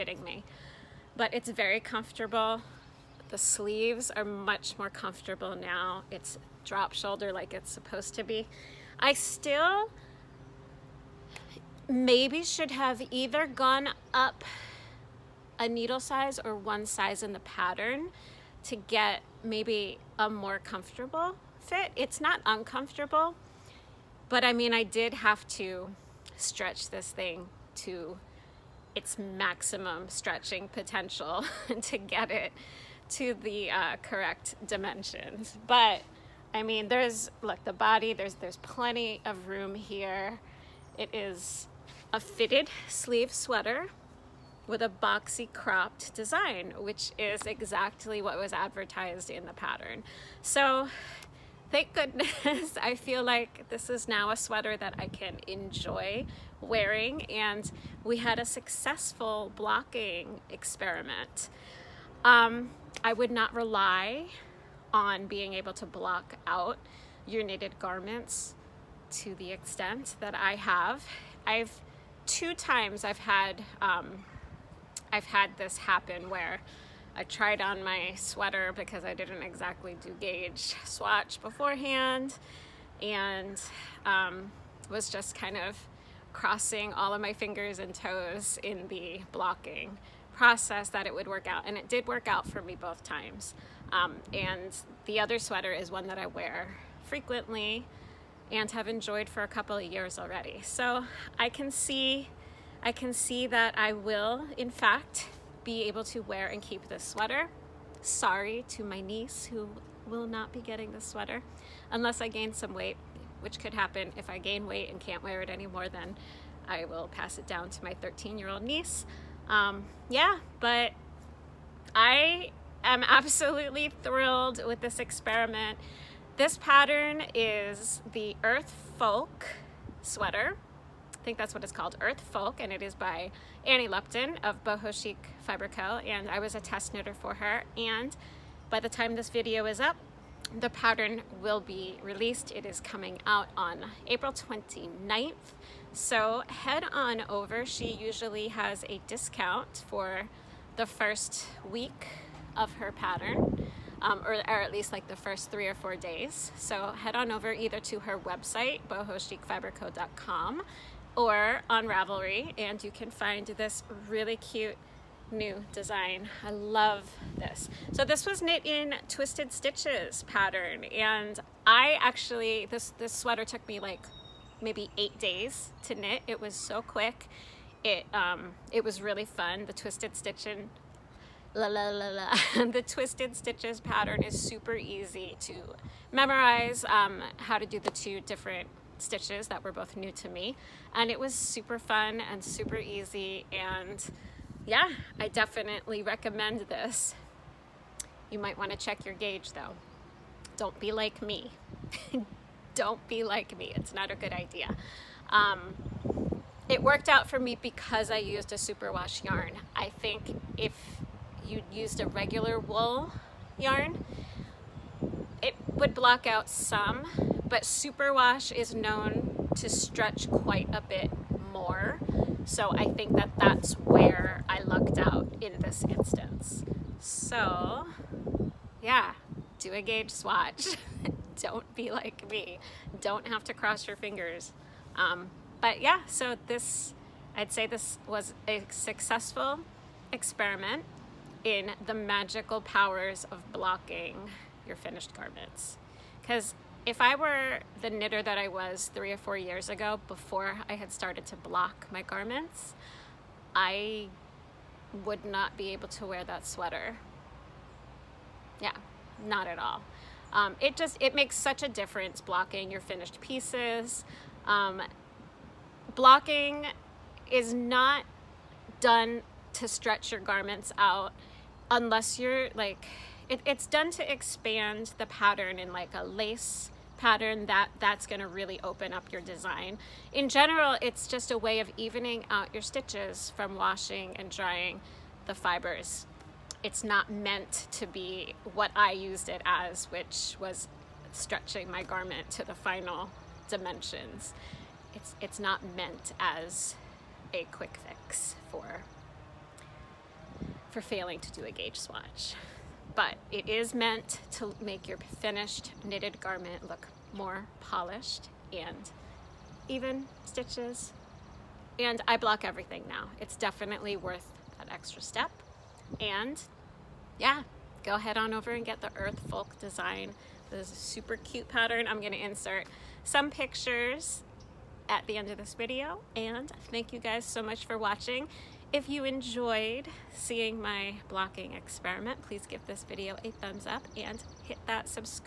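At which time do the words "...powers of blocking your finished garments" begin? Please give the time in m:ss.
4:02.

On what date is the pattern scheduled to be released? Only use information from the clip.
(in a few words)
April 29th.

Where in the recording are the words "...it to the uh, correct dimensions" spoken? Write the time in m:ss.
0:32.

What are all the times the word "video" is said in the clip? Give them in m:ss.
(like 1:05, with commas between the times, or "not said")
2:19, 5:25, 5:32.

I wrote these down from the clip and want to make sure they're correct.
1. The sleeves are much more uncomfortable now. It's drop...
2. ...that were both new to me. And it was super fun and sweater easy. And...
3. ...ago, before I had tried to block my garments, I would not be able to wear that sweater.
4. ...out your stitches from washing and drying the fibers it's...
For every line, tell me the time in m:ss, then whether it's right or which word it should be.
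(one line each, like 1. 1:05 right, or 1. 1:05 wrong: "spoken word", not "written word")
1. 0:03 wrong: "comfortable", not "uncomfortable"
2. 3:09 wrong: "super", not "sweater"
3. 4:09 wrong: "started", not "tried"
4. 4:42 right.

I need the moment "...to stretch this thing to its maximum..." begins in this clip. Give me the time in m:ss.
0:25.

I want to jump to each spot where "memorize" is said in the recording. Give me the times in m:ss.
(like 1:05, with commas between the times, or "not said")
3:06.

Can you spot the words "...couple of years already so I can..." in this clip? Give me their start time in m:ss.
1:39.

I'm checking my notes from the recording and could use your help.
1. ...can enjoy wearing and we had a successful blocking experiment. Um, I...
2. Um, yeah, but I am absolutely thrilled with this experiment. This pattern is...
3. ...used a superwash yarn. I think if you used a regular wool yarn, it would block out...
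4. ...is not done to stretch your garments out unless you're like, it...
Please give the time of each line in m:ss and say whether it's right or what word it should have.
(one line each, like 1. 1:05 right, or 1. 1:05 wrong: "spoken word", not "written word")
1. 0:55 right
2. 1:59 right
3. 3:28 right
4. 4:27 right.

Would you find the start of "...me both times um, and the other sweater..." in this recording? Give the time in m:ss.
1:32.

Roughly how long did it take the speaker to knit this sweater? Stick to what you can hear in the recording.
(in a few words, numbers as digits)
8 days.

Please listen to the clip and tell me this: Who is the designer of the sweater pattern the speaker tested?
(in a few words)
Annie Lupton.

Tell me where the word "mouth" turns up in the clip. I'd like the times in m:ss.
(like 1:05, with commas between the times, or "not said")
not said.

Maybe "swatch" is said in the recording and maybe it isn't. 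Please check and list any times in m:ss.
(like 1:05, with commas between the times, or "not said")
1:20, 3:50, 5:01.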